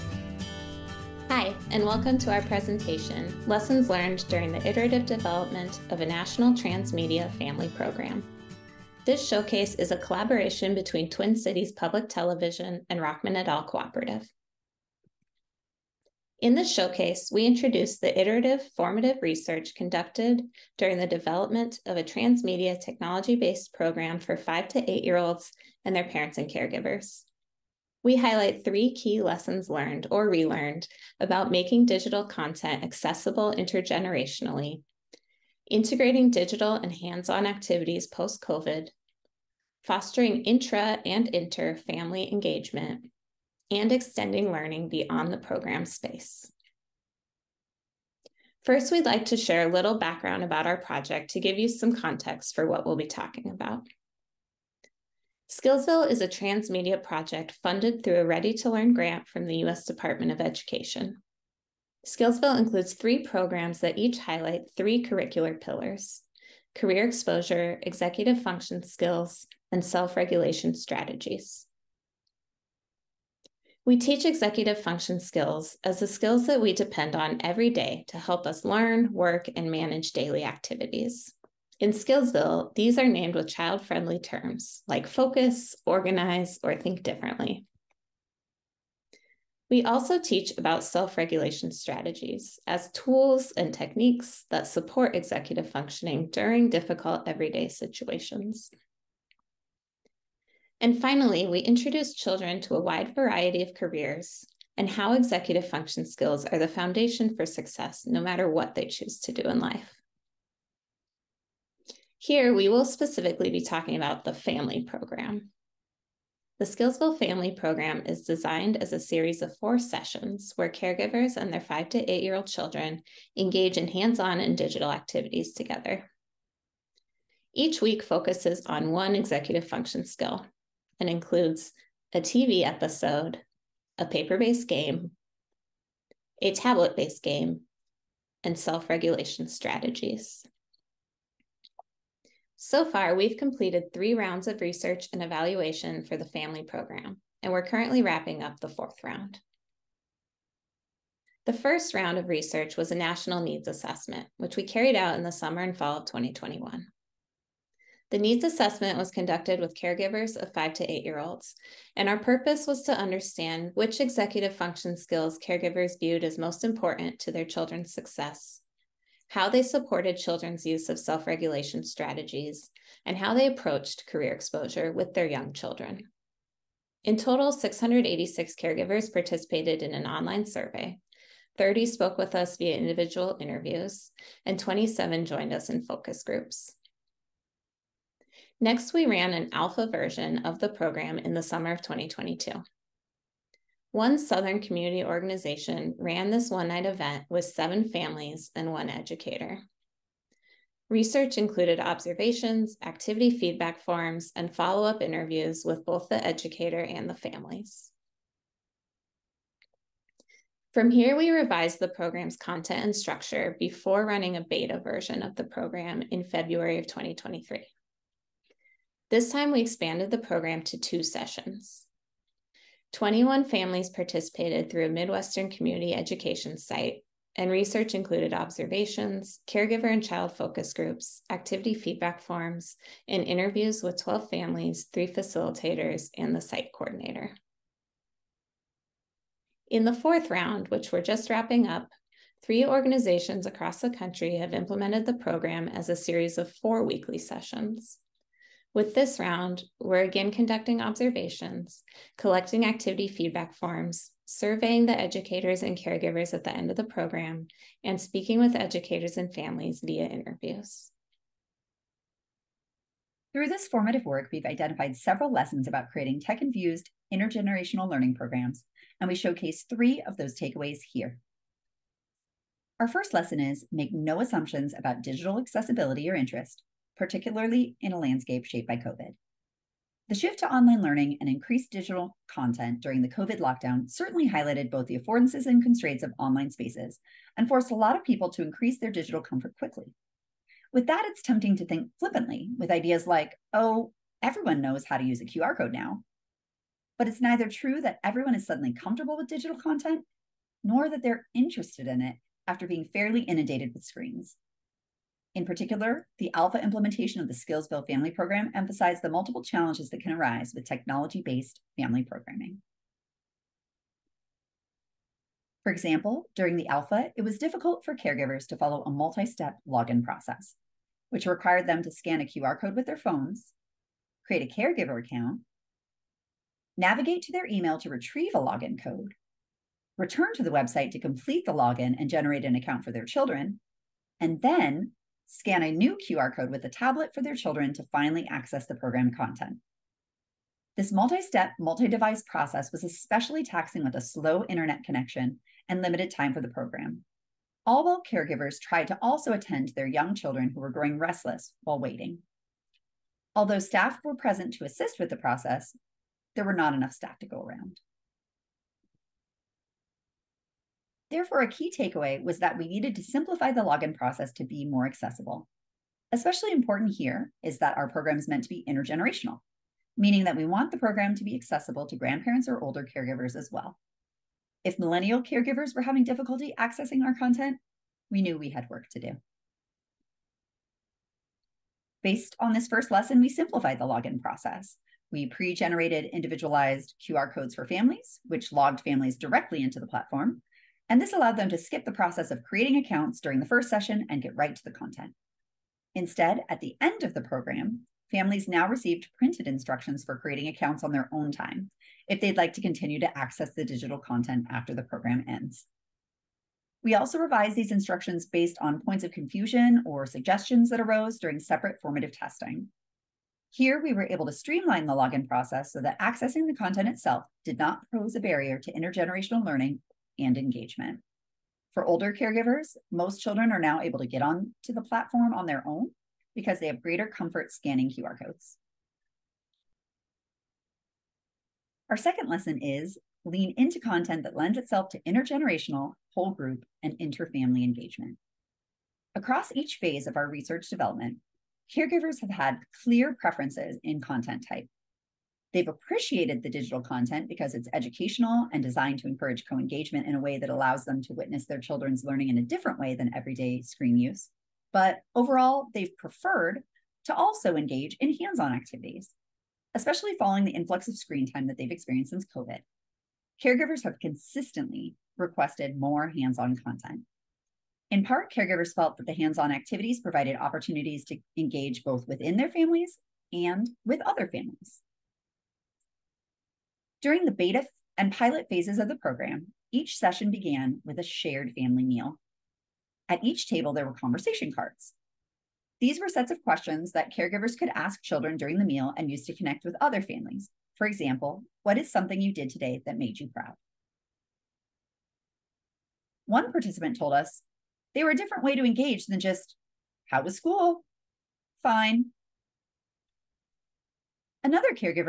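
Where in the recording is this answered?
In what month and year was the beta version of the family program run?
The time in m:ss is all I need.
3:36.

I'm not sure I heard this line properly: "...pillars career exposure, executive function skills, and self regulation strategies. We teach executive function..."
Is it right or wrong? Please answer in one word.
right.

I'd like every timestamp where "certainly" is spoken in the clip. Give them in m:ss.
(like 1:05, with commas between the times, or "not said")
4:43.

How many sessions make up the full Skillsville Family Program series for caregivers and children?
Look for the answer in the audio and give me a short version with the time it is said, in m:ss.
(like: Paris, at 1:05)
4, at 1:59.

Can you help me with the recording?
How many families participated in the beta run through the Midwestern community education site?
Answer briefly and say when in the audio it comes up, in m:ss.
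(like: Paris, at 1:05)
21, at 3:42.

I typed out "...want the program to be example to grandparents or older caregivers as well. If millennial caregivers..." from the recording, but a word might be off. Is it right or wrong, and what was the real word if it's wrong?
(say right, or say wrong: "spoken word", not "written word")
wrong: "accessible", not "example".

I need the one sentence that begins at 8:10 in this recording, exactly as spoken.
For example, what is something you did today that made you proud?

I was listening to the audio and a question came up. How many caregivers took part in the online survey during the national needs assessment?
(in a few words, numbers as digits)
686.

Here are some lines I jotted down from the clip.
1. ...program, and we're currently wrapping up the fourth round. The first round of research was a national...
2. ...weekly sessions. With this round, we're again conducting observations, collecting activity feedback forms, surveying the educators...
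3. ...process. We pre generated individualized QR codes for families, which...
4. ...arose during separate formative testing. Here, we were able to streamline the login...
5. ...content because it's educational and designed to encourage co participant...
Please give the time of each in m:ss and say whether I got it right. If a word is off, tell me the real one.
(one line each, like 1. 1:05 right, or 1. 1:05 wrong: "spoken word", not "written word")
1. 2:26 right
2. 4:06 right
3. 6:24 right
4. 6:50 right
5. 7:26 wrong: "engagement", not "participant".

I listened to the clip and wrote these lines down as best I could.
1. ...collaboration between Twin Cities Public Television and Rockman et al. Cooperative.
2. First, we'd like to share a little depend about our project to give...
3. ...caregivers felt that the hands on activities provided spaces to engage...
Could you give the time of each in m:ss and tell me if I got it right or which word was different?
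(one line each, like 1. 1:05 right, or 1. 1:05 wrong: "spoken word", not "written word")
1. 0:09 right
2. 0:48 wrong: "background", not "depend"
3. 7:48 wrong: "opportunities", not "spaces".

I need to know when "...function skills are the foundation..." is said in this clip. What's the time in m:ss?
1:45.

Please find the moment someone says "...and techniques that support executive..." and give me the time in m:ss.
1:33.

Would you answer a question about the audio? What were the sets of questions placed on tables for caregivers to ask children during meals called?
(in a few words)
conversation cards.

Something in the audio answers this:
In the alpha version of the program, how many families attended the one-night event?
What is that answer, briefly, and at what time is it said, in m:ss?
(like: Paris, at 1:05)
7, at 3:17.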